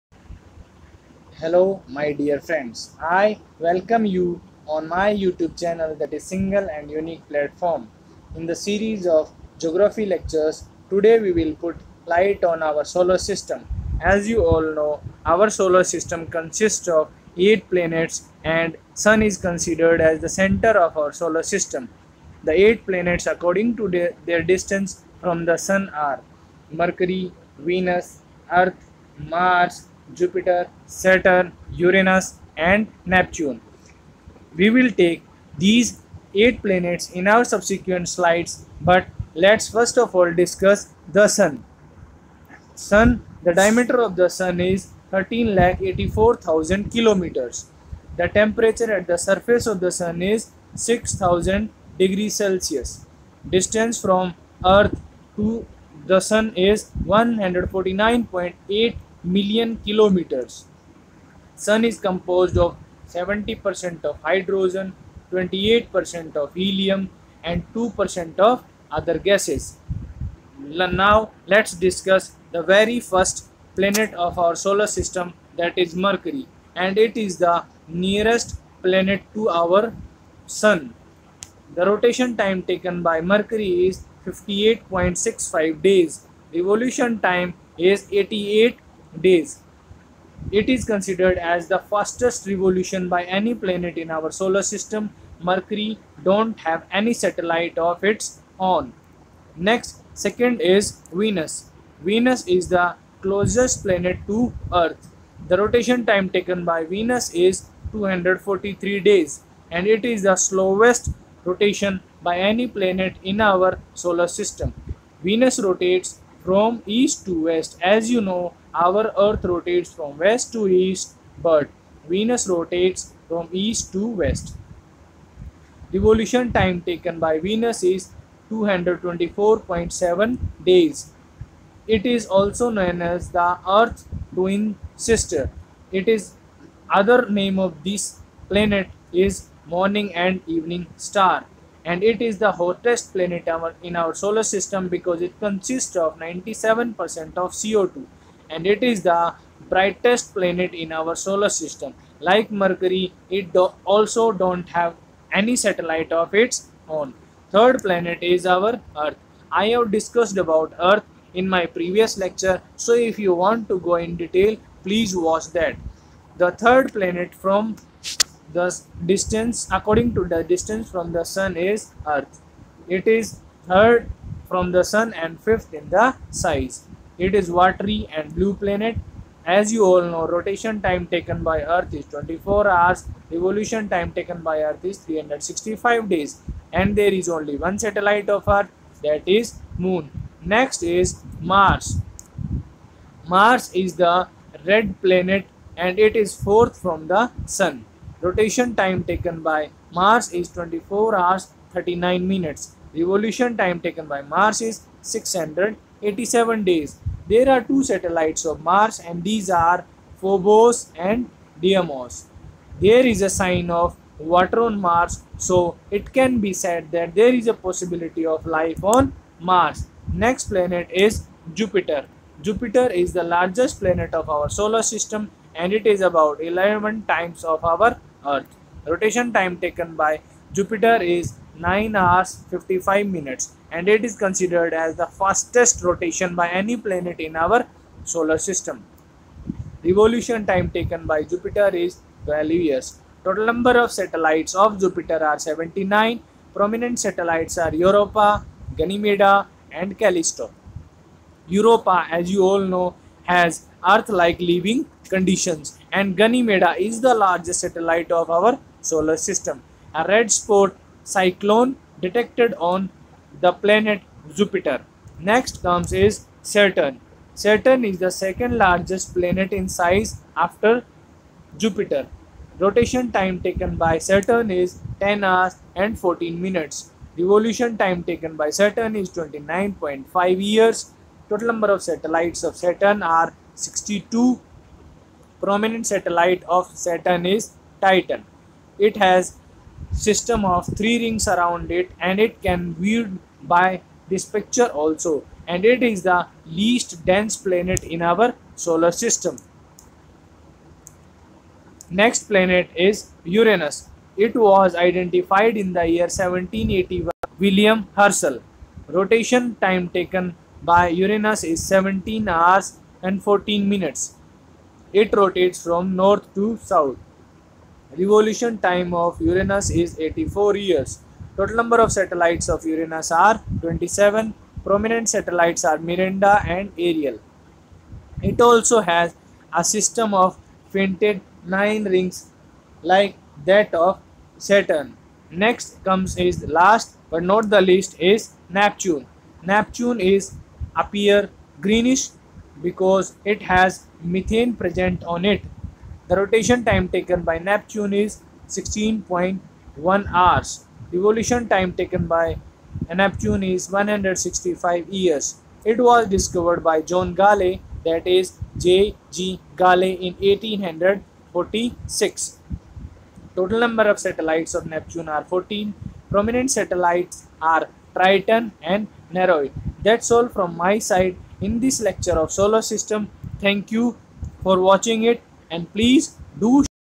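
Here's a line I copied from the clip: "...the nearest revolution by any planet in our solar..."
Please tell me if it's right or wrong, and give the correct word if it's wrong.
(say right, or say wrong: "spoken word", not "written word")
wrong: "fastest", not "nearest".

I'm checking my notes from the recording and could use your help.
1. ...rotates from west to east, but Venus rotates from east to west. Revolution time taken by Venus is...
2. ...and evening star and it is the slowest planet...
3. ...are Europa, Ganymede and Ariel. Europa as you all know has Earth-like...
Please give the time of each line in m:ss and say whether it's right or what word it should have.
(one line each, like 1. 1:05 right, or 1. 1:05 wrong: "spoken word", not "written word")
1. 1:59 right
2. 2:20 wrong: "hottest", not "slowest"
3. 4:07 wrong: "Callisto", not "Ariel".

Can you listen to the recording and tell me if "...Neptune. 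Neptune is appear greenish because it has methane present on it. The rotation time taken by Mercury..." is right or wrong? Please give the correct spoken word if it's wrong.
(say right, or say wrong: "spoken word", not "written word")
wrong: "Neptune", not "Mercury".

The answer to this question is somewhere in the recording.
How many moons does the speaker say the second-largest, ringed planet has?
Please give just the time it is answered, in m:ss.
4:43.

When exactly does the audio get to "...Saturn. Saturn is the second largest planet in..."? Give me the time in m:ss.
4:26.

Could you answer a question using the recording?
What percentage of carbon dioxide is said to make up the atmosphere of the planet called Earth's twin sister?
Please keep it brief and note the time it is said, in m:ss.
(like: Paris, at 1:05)
97%, at 2:26.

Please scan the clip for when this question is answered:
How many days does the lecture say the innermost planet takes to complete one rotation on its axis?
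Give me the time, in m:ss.
1:24.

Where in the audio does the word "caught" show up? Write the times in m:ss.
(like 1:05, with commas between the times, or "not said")
not said.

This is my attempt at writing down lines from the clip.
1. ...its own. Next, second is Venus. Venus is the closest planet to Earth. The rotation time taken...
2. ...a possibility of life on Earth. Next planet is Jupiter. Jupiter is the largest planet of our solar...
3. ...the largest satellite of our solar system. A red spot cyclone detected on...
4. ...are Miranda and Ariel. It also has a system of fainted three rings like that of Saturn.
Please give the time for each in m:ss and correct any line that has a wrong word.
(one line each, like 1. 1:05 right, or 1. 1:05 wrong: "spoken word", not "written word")
1. 1:38 right
2. 3:37 wrong: "Mars", not "Earth"
3. 4:17 right
4. 5:25 wrong: "nine", not "three".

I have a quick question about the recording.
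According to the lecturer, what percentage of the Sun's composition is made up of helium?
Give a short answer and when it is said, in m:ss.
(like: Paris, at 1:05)
28%, at 1:05.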